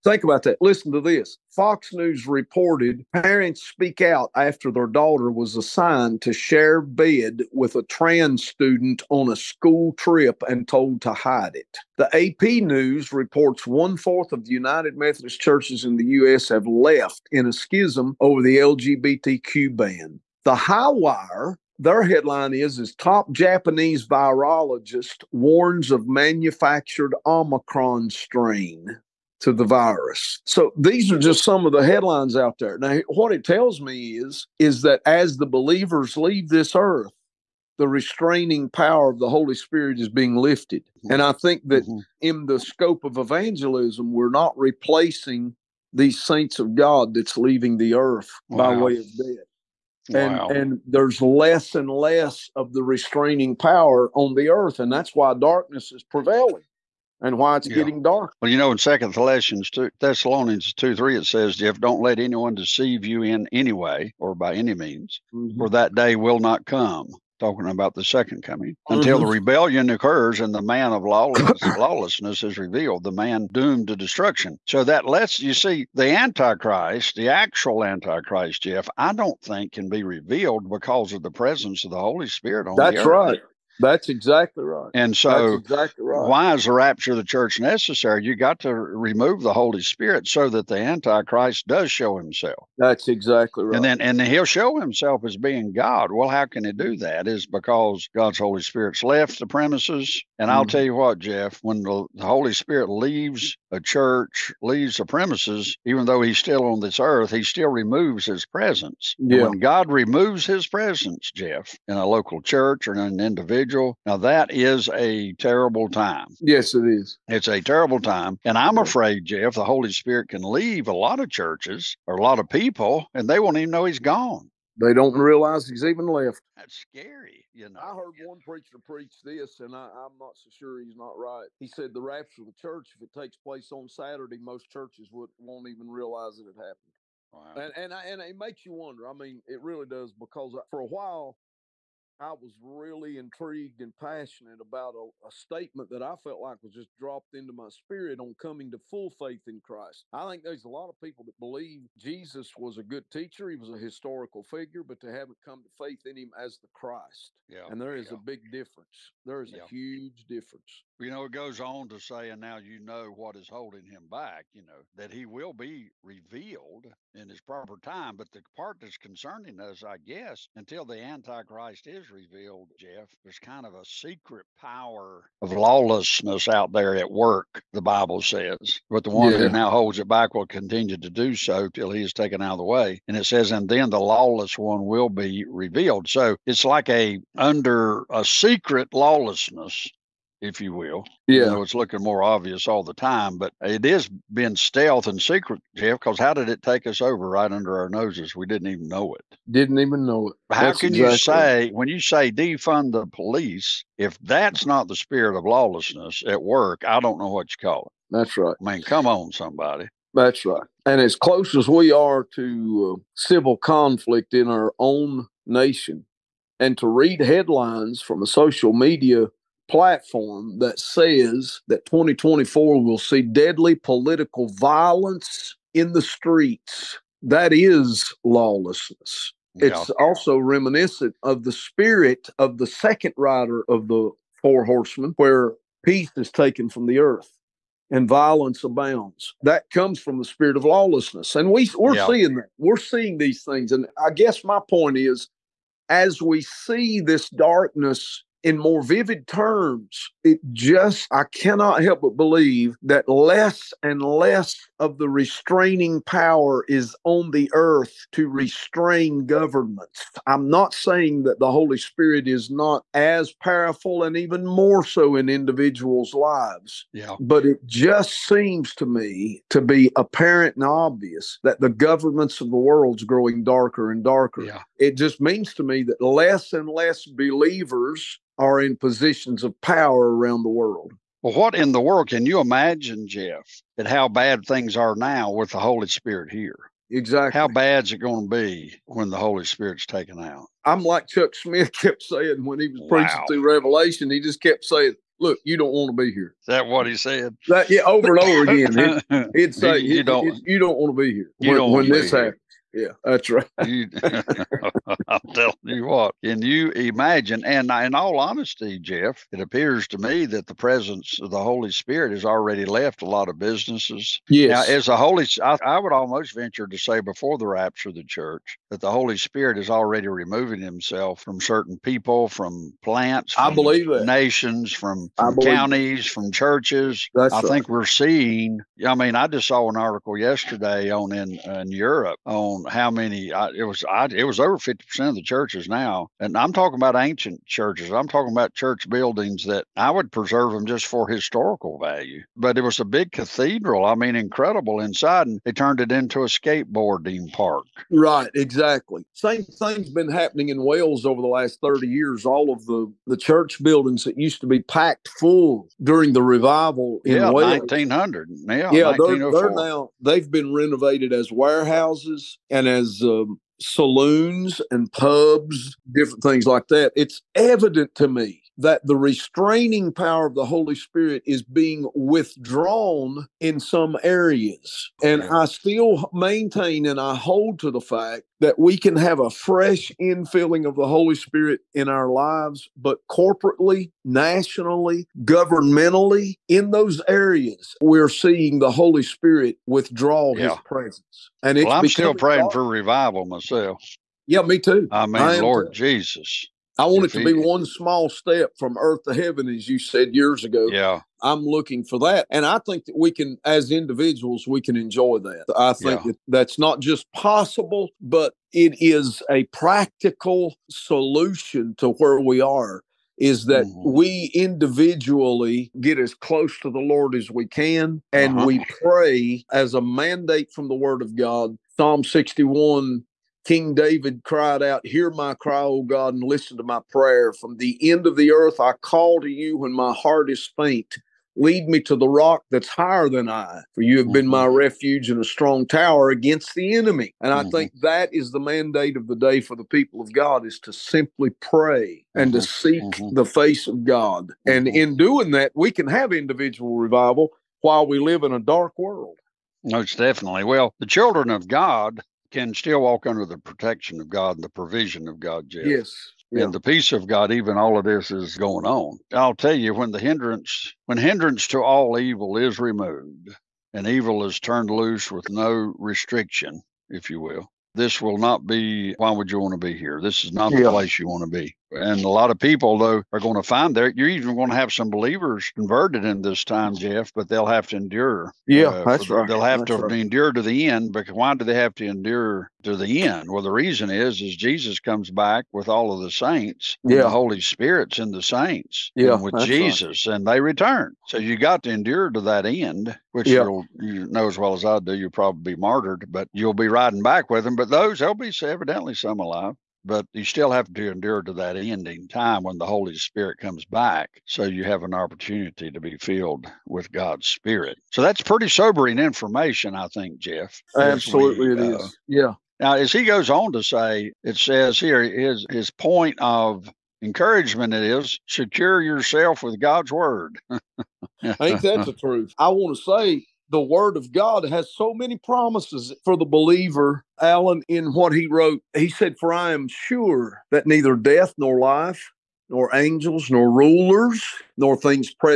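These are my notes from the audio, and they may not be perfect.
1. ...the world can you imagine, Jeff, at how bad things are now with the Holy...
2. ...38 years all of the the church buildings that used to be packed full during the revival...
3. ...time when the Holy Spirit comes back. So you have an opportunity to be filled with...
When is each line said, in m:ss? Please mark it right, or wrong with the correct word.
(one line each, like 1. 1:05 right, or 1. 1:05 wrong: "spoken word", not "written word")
1. 4:41 right
2. 5:51 wrong: "30", not "38"
3. 8:22 right.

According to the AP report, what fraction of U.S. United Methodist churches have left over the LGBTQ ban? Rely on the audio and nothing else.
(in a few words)
One fourth.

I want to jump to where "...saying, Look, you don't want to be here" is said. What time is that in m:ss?
4:54.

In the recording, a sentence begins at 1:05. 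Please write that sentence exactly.
for that day will not come talking about the second coming until mm-hmm.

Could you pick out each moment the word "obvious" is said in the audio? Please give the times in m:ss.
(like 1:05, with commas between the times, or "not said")
3:12, 4:30.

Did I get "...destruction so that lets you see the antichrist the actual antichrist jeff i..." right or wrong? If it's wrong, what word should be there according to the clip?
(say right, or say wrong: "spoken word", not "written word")
right.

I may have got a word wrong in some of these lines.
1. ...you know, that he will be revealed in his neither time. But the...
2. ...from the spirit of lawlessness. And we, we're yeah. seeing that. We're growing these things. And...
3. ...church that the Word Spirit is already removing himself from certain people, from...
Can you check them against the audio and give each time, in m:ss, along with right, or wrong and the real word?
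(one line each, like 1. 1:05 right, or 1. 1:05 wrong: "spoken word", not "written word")
1. 2:44 wrong: "proper", not "neither"
2. 3:59 wrong: "seeing", not "growing"
3. 5:18 wrong: "Holy", not "Word".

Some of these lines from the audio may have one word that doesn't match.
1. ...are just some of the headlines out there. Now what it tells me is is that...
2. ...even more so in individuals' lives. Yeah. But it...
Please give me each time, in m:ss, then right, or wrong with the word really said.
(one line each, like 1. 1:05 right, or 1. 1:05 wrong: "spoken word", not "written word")
1. 0:31 right
2. 4:24 right.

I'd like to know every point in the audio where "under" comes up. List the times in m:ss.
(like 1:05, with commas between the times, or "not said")
3:07, 3:17, 7:33.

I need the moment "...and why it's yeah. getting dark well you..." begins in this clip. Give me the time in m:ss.
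0:57.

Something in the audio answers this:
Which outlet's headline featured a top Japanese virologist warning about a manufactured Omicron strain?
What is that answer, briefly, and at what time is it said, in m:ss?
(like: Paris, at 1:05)
The High Wire, at 0:20.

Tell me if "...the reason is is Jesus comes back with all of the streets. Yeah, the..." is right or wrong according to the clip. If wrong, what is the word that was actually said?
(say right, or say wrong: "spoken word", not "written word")
wrong: "saints", not "streets".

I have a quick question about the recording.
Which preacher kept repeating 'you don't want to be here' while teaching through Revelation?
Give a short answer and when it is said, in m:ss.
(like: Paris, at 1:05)
Chuck Smith, at 4:51.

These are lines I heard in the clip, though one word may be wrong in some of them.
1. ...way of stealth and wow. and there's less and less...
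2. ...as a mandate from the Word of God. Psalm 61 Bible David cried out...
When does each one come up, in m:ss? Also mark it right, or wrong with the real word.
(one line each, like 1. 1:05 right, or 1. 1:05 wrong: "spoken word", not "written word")
1. 0:48 wrong: "death", not "stealth"
2. 6:59 wrong: "King", not "Bible".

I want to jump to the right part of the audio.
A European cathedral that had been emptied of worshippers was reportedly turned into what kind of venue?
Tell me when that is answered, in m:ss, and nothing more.
5:46.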